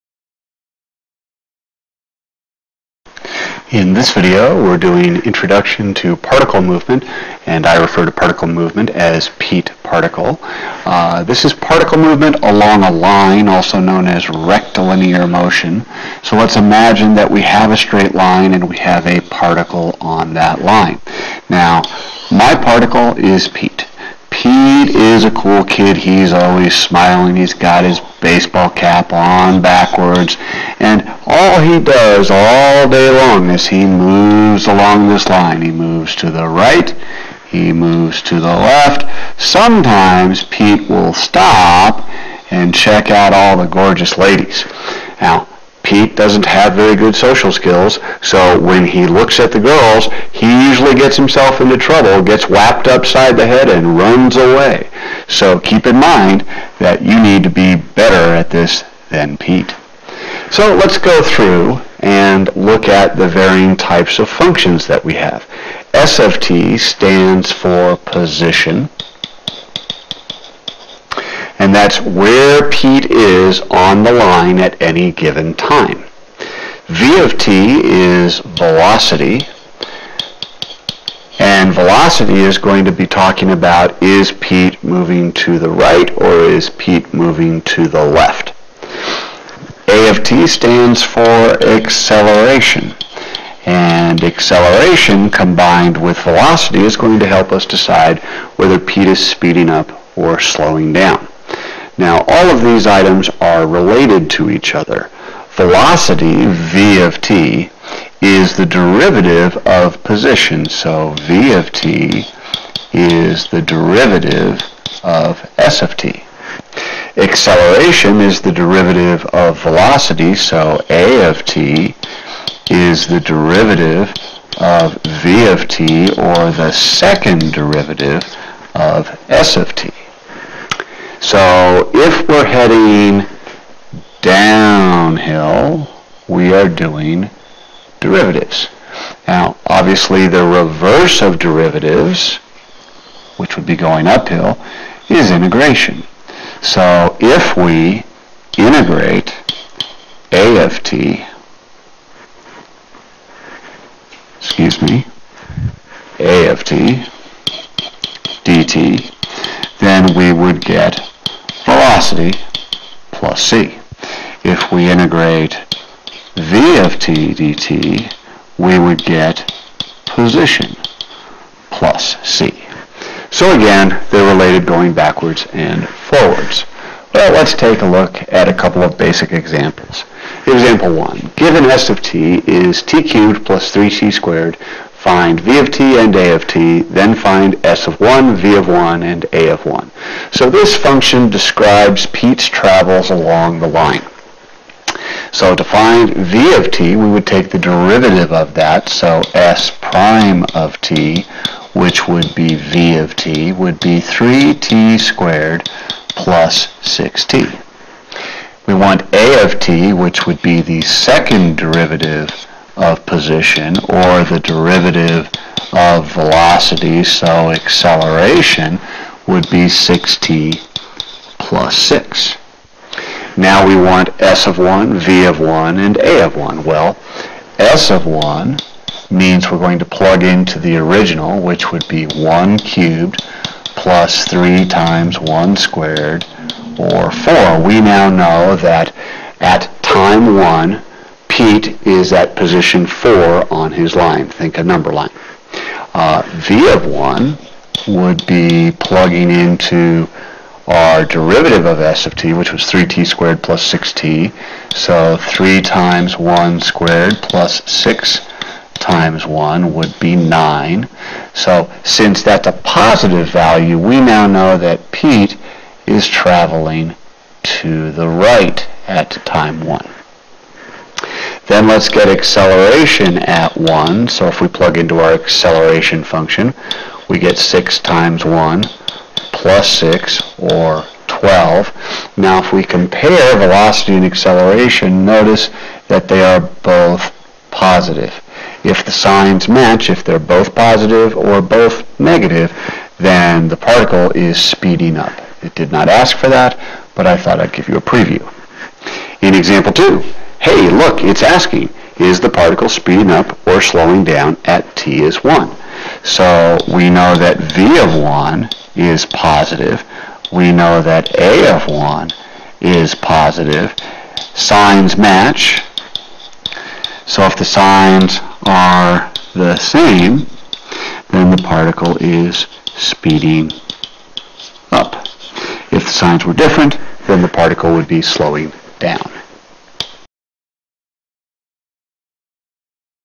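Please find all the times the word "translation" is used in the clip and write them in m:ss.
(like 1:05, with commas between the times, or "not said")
not said.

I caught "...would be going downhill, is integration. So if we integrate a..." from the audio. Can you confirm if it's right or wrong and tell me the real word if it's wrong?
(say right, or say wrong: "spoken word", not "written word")
wrong: "uphill", not "downhill".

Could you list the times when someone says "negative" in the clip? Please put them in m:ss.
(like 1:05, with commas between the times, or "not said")
4:51.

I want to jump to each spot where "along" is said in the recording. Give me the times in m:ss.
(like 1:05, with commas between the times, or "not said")
0:12, 0:34, 3:13.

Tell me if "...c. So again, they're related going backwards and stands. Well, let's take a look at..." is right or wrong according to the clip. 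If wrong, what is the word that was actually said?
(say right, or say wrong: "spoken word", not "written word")
wrong: "forwards", not "stands".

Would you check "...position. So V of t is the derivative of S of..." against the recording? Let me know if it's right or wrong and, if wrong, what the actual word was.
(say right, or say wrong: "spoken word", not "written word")
right.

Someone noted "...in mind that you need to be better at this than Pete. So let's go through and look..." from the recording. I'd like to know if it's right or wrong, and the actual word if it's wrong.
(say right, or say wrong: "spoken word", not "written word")
right.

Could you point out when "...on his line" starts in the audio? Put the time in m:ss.
4:03.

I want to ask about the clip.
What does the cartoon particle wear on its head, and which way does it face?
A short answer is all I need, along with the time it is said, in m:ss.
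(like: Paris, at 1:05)
baseball cap on backwards, at 0:28.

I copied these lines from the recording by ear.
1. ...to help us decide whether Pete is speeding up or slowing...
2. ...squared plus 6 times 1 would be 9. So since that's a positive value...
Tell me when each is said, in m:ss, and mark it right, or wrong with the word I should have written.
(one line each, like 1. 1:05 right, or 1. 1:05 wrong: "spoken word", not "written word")
1. 1:37 right
2. 4:16 right.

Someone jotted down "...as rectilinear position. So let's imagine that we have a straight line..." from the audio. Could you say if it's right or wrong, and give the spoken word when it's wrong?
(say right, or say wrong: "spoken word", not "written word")
wrong: "motion", not "position".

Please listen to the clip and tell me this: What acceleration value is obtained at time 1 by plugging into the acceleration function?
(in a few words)
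12.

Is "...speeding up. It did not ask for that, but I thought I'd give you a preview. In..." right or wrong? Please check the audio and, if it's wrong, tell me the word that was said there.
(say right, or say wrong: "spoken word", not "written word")
right.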